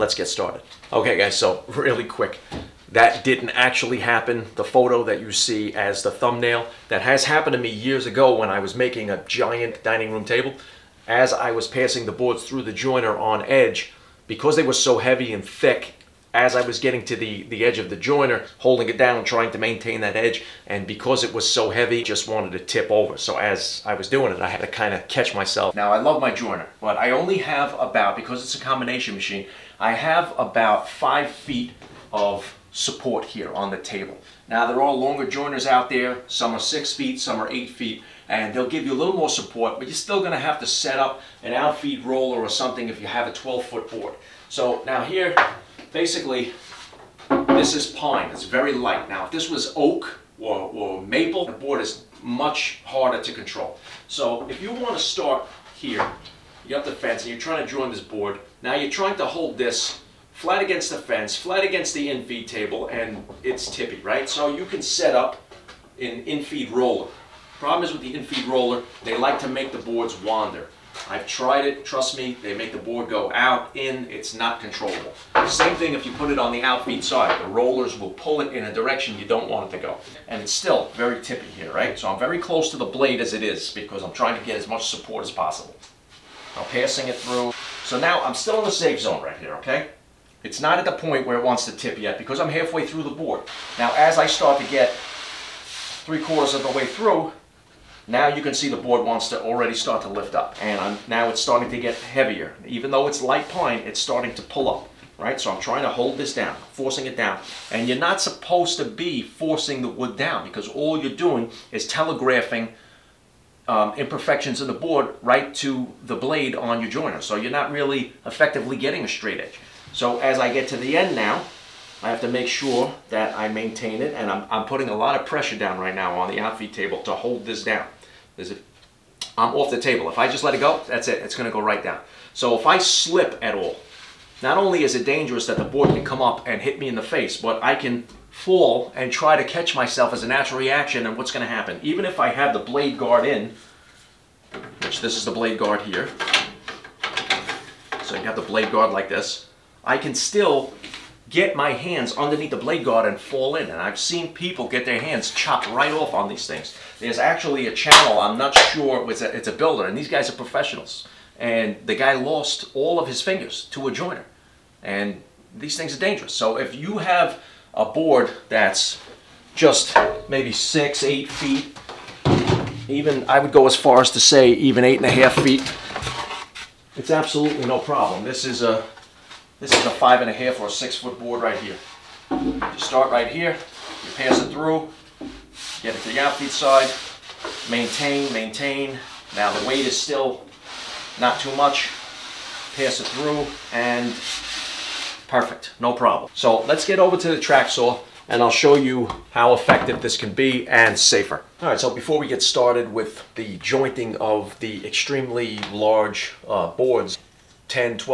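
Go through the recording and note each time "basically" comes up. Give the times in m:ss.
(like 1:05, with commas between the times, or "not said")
0:45.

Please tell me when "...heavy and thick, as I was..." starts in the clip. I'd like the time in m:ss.
0:14.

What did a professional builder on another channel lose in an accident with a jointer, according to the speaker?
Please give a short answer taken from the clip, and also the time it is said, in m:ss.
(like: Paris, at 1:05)
All of his fingers, at 2:42.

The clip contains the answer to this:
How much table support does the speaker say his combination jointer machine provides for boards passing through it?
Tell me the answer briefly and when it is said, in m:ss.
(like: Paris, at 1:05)
5 feet, at 0:30.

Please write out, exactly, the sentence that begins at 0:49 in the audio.
Now if this was oak or, or maple, the board is much harder to control.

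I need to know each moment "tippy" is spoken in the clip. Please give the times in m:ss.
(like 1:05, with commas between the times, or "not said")
1:03, 1:21.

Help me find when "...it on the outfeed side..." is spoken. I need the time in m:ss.
1:16.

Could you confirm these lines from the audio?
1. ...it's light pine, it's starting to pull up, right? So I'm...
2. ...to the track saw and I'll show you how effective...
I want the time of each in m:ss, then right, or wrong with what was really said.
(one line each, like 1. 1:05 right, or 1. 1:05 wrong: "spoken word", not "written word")
1. 1:43 right
2. 3:17 right.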